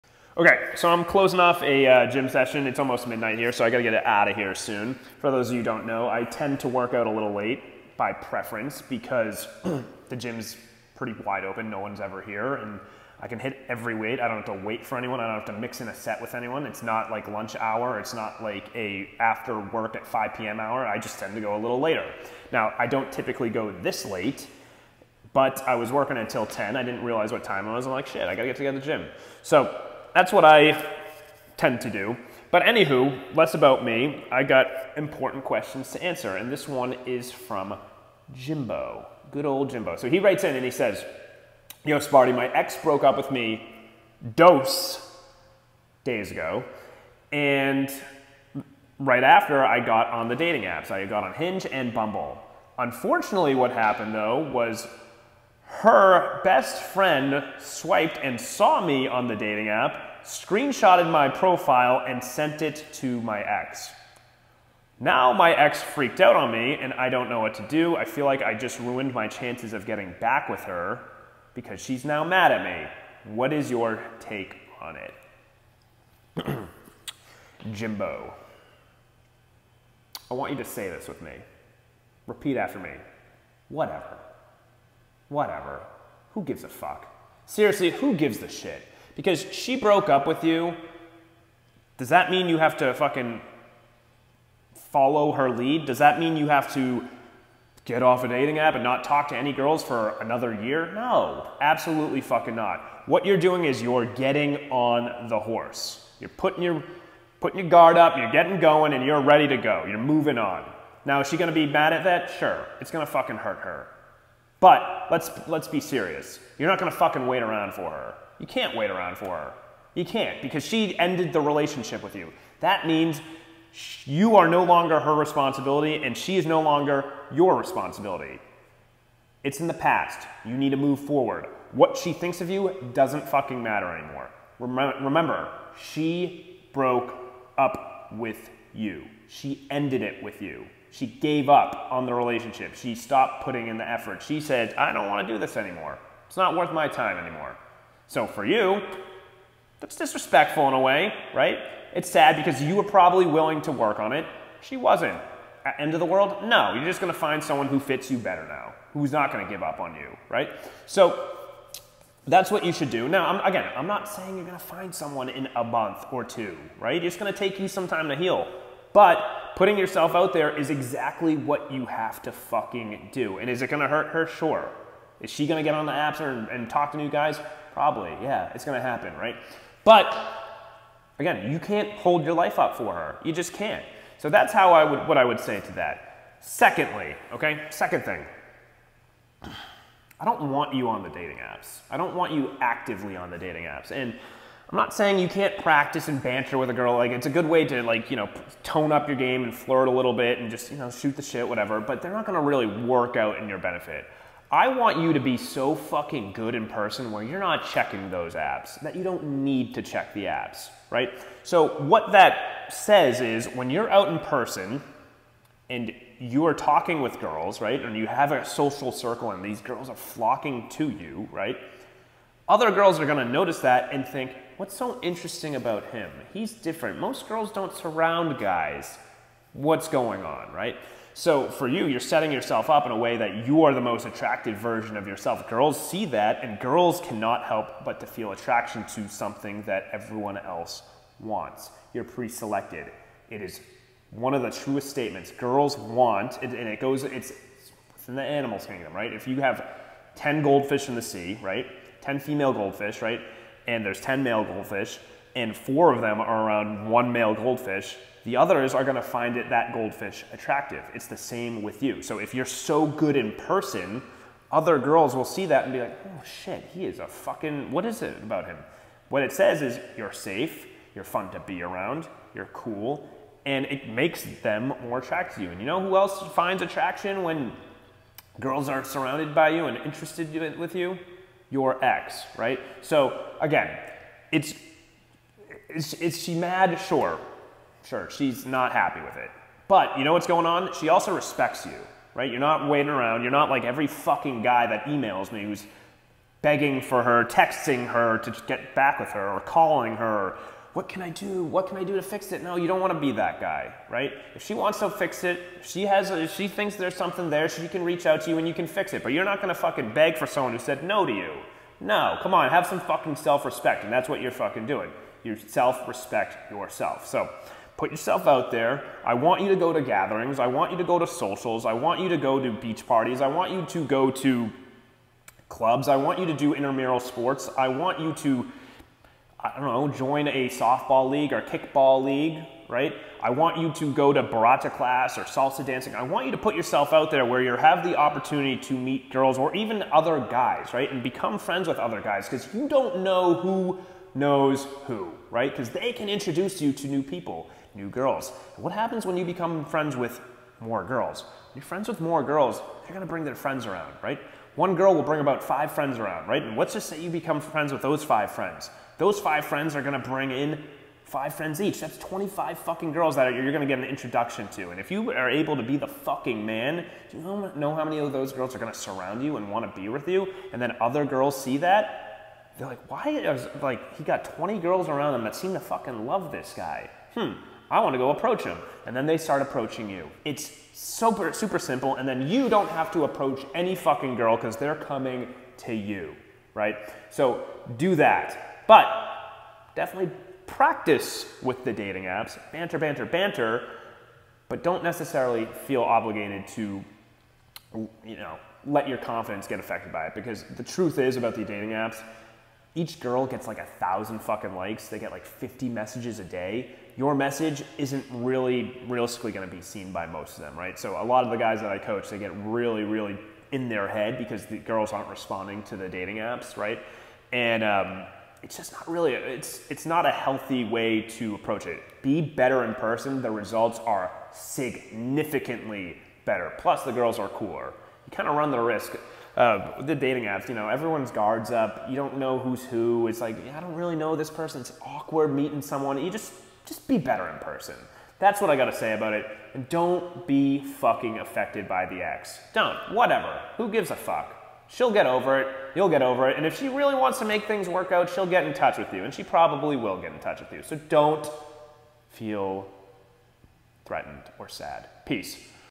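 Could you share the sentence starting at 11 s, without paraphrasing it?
No one's ever here, and I can hit every weight.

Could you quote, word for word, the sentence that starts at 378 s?
And then they start approaching you.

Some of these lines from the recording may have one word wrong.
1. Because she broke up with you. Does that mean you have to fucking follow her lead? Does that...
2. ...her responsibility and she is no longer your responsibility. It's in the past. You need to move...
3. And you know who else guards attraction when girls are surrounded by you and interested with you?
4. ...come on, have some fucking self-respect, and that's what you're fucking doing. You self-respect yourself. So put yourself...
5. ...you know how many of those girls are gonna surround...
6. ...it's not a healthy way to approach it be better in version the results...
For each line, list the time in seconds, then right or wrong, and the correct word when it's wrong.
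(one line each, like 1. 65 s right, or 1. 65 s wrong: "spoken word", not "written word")
1. 89 s right
2. 124 s right
3. 275 s wrong: "finds", not "guards"
4. 312 s right
5. 367 s right
6. 419 s wrong: "person", not "version".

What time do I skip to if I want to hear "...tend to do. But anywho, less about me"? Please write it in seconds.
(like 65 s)
31 s.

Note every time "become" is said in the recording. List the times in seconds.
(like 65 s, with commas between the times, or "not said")
341 s, 349 s, 357 s.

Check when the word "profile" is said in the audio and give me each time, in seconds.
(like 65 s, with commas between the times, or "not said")
61 s.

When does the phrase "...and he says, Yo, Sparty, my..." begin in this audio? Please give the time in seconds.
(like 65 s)
40 s.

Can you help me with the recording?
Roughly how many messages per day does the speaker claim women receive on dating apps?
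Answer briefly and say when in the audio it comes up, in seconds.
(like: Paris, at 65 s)
50, at 405 s.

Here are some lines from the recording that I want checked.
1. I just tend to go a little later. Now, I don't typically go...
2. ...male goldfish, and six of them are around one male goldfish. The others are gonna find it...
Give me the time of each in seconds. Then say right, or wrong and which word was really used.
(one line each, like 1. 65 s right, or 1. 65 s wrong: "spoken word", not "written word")
1. 20 s right
2. 254 s wrong: "four", not "six".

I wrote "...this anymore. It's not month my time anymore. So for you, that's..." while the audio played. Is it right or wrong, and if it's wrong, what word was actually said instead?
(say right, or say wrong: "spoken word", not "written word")
wrong: "worth", not "month".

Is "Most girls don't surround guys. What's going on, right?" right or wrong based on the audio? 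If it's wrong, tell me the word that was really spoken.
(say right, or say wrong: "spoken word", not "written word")
right.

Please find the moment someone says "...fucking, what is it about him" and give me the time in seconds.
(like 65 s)
267 s.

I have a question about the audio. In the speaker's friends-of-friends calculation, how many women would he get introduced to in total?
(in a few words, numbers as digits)
25.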